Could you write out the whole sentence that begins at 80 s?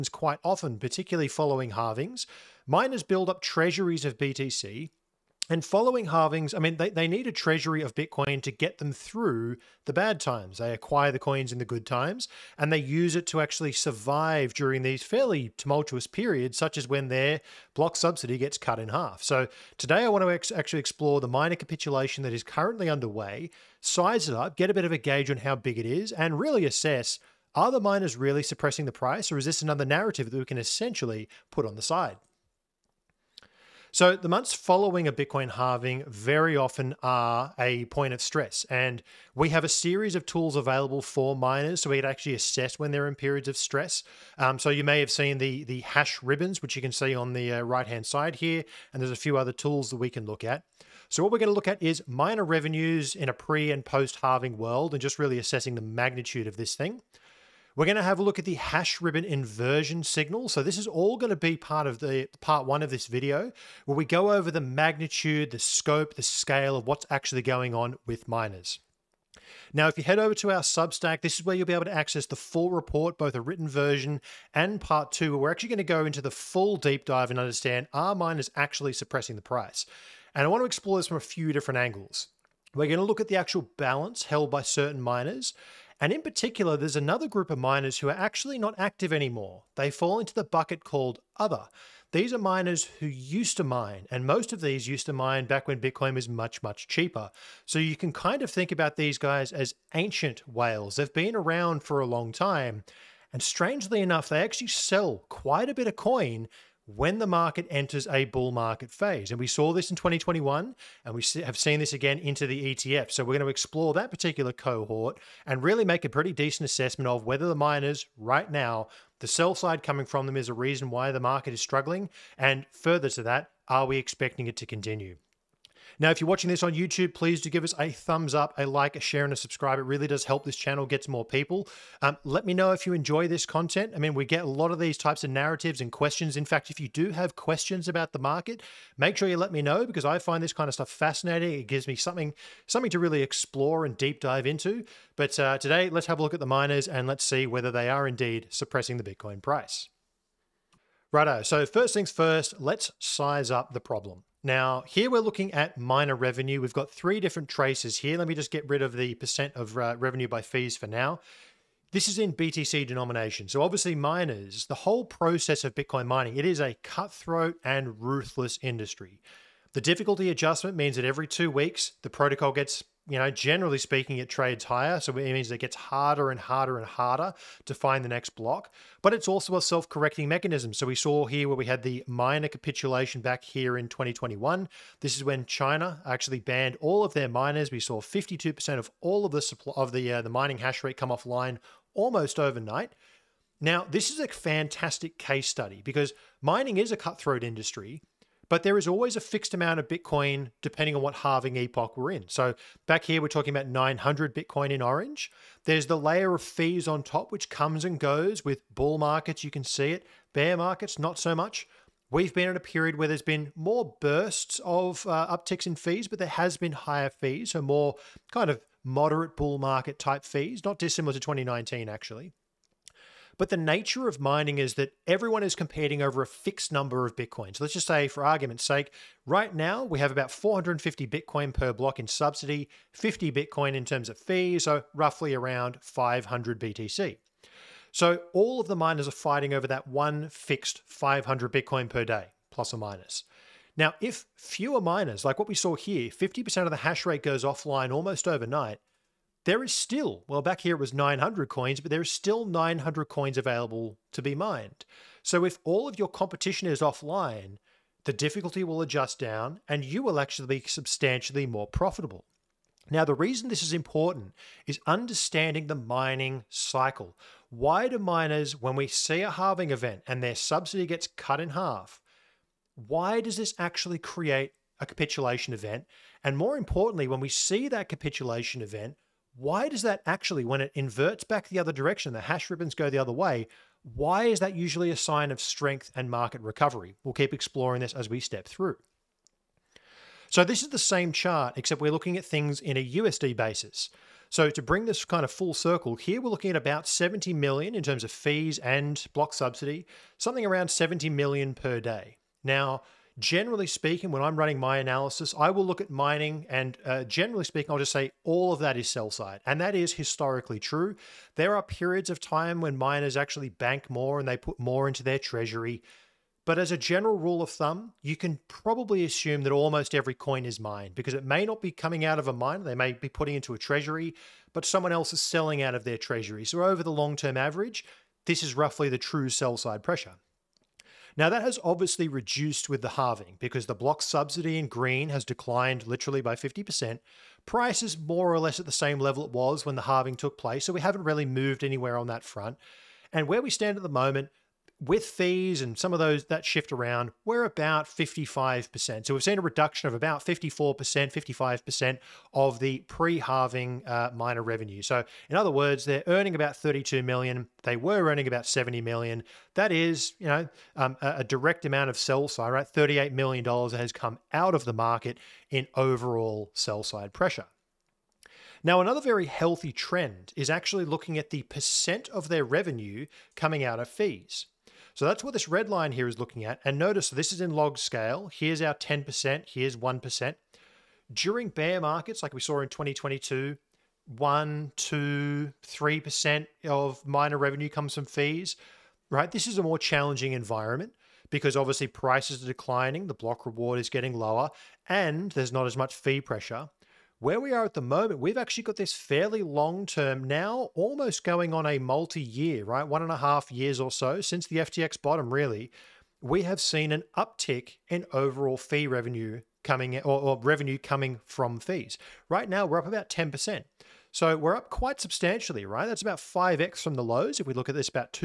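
And I want to explore this from a few different angles.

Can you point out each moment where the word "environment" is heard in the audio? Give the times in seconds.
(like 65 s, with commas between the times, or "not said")
390 s.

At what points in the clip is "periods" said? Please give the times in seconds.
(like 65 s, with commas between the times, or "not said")
16 s, 43 s, 212 s, 311 s.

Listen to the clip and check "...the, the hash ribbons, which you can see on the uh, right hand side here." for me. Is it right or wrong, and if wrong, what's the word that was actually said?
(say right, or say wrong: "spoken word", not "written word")
right.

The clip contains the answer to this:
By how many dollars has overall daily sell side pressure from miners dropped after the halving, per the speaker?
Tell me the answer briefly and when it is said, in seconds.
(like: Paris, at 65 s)
38 million dollars, at 362 s.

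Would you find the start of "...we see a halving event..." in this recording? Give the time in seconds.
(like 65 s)
268 s.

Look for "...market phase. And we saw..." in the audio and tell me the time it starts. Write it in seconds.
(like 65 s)
108 s.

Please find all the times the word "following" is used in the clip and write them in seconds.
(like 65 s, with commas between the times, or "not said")
1 s, 5 s, 34 s.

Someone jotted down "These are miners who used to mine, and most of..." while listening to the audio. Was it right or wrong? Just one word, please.
right.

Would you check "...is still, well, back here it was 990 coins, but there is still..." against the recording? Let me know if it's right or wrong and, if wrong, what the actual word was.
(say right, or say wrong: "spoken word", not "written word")
wrong: "900", not "990".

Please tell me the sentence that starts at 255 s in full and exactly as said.
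So if all of your competition is offline, the difficulty will adjust down and you will actually be substantially more profitable.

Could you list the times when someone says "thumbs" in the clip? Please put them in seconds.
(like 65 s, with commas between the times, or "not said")
127 s, 317 s.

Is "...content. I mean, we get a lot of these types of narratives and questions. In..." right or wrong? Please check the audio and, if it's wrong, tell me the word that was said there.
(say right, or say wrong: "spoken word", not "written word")
right.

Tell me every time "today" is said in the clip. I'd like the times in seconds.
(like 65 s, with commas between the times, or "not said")
19 s, 145 s.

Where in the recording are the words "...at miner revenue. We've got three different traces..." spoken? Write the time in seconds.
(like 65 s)
155 s.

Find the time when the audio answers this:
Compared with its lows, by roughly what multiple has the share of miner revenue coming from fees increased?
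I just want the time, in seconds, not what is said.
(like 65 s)
416 s.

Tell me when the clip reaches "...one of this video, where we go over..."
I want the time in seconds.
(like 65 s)
62 s.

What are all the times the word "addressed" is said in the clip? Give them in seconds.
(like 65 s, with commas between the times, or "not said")
not said.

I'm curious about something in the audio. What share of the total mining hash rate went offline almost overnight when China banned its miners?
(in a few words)
52%.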